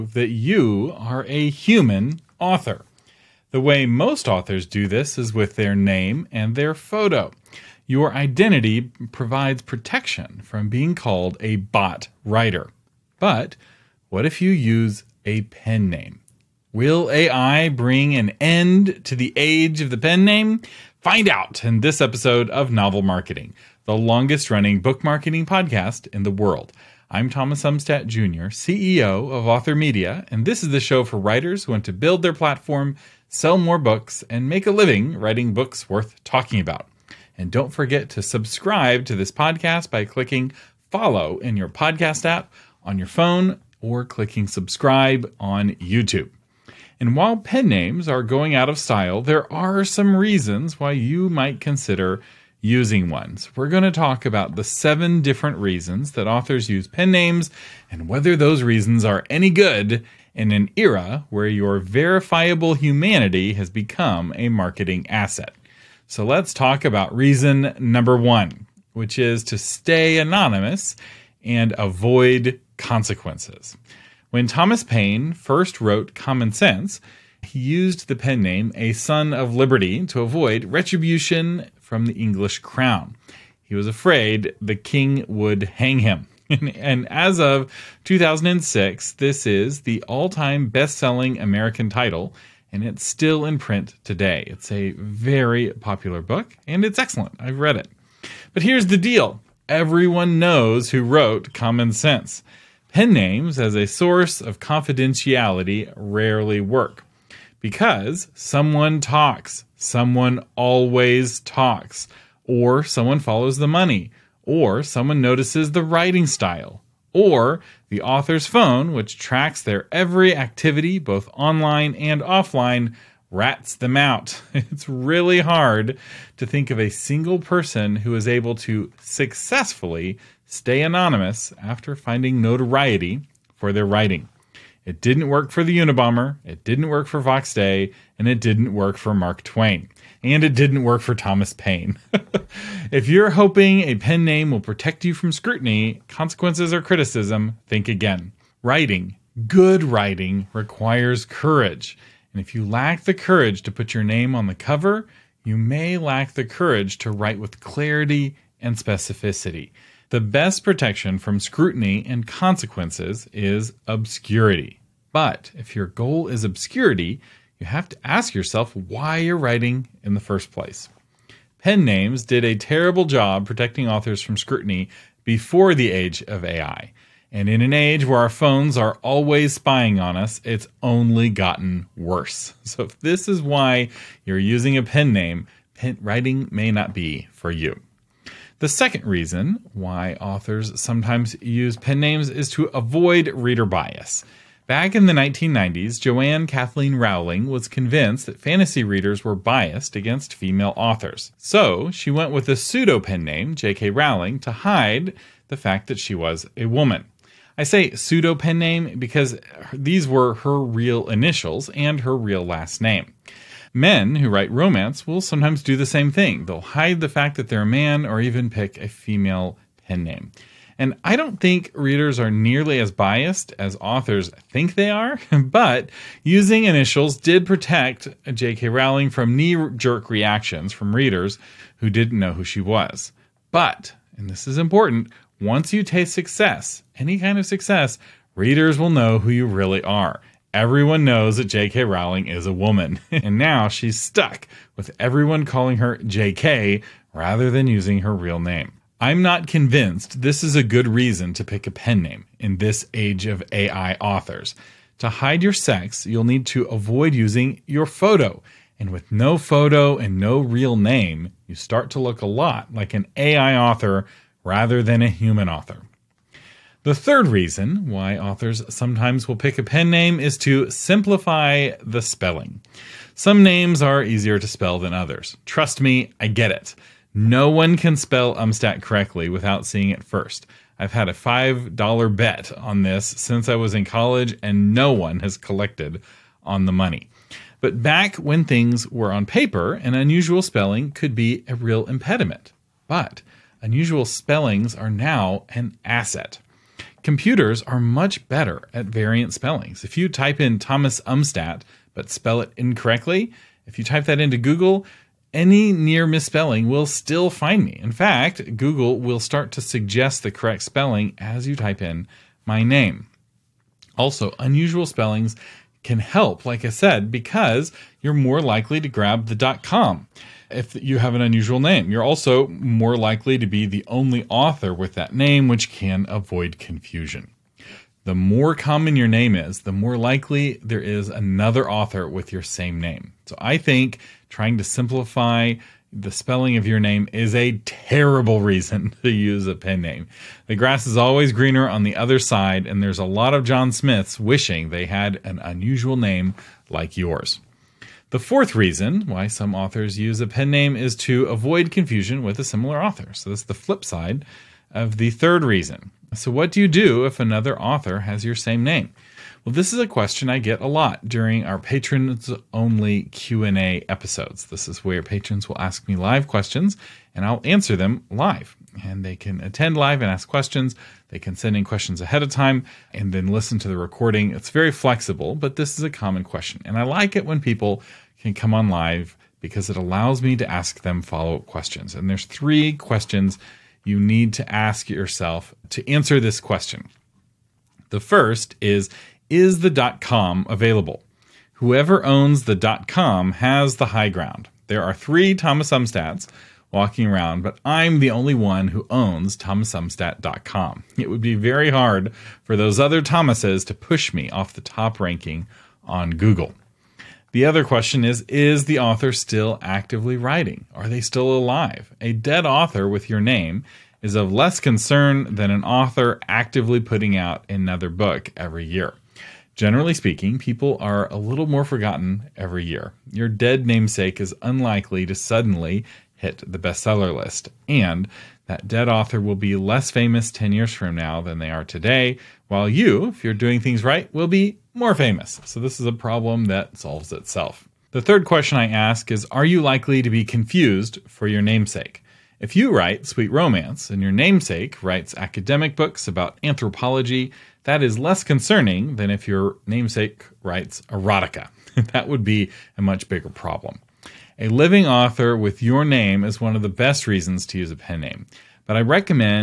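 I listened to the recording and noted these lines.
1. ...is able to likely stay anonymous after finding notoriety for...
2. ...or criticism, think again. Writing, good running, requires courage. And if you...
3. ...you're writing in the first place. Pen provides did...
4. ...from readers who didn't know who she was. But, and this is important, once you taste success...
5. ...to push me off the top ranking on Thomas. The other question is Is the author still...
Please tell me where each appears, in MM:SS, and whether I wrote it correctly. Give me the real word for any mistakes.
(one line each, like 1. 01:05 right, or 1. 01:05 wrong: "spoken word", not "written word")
1. 02:08 wrong: "successfully", not "likely"
2. 02:26 wrong: "writing", not "running"
3. 02:49 wrong: "names", not "provides"
4. 03:50 right
5. 06:43 wrong: "Google", not "Thomas".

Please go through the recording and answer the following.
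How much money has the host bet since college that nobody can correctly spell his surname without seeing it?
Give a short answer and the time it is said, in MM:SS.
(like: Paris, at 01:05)
$5, at 04:41.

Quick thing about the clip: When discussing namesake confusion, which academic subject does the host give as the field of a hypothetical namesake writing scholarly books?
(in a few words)
anthropology.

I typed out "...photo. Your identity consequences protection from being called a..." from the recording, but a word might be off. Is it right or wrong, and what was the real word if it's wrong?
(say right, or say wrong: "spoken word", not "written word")
wrong: "provides", not "consequences".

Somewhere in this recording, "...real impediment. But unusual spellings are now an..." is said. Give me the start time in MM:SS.
04:51.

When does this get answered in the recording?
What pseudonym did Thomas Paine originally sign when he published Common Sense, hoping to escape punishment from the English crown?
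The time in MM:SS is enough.
01:18.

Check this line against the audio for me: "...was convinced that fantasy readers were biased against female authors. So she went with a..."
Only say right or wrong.
right.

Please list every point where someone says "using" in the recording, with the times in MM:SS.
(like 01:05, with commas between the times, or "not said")
00:52, 03:04, 03:46, 04:07, 04:17.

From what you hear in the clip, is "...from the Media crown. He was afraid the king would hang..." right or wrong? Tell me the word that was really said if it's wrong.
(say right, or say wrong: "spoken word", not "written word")
wrong: "English", not "Media".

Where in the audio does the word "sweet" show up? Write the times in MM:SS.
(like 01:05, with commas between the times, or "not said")
07:23.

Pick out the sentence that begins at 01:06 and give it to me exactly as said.
So let's talk about reason number one, which is to stay anonymous and avoid consequences.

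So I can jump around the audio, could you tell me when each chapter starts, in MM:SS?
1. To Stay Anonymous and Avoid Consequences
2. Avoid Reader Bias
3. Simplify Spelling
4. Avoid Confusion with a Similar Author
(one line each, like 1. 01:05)
1. 01:05
2. 03:07
3. 04:26
4. 05:47.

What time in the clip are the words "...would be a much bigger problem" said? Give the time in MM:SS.
07:32.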